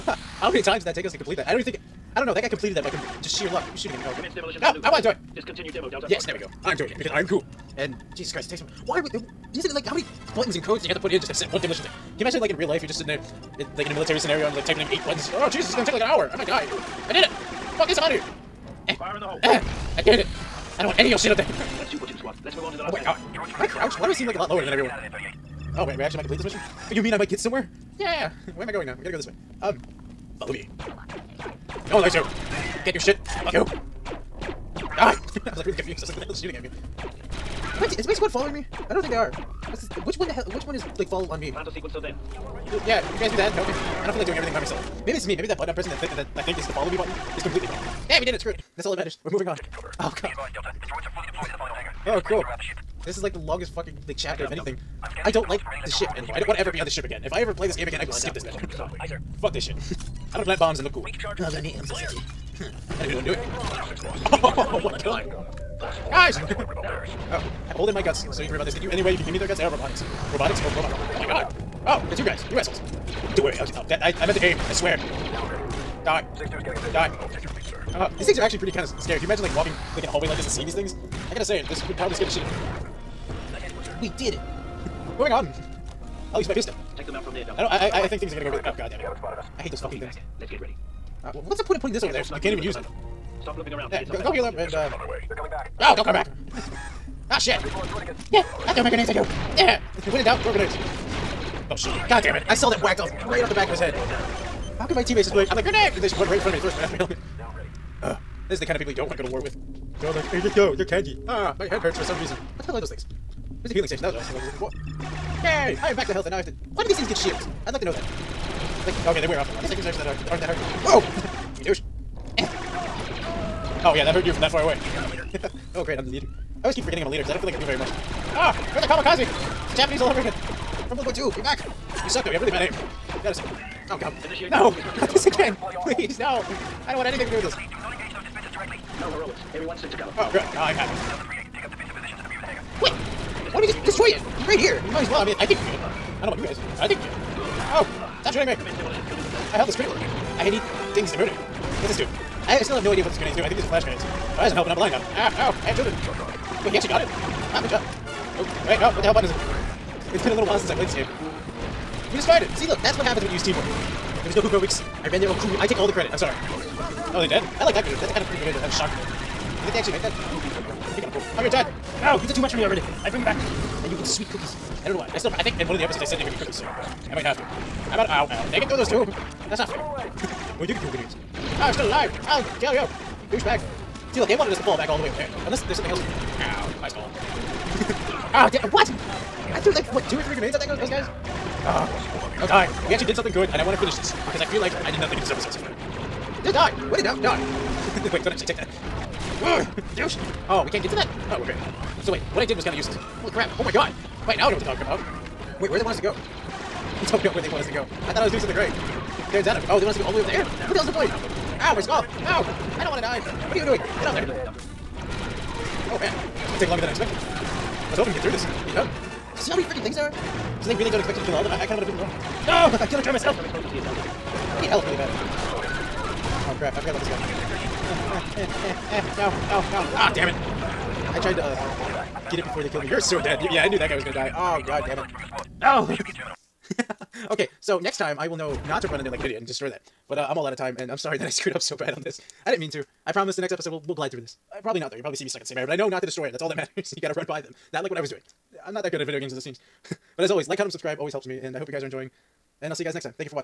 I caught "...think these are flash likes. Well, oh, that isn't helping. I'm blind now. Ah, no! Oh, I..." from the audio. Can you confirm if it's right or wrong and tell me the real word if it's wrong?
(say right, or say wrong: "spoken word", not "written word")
wrong: "grenades", not "likes".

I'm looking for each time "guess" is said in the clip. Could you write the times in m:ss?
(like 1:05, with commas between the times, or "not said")
not said.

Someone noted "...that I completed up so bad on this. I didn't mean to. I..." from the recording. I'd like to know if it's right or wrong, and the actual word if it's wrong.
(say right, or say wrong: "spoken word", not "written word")
wrong: "screwed", not "completed".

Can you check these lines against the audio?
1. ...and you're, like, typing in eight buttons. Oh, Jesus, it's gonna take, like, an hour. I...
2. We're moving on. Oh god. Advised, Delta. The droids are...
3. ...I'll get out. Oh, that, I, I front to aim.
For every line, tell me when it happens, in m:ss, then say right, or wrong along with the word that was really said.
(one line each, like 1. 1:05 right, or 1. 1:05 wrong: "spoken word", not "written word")
1. 0:14 right
2. 0:49 right
3. 1:13 wrong: "meant", not "front".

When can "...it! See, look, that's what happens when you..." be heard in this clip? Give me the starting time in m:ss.
2:42.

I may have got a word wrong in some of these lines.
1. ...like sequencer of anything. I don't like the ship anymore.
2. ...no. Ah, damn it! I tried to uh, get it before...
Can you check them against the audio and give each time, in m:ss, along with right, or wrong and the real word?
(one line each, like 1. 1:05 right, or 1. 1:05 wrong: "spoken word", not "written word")
1. 0:54 wrong: "chapter", not "sequencer"
2. 3:49 right.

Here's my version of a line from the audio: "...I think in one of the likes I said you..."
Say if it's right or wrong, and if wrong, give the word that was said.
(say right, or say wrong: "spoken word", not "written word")
wrong: "episodes", not "likes".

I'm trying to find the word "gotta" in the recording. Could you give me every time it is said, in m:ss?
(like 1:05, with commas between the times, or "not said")
0:29, 1:21, 2:13, 4:07.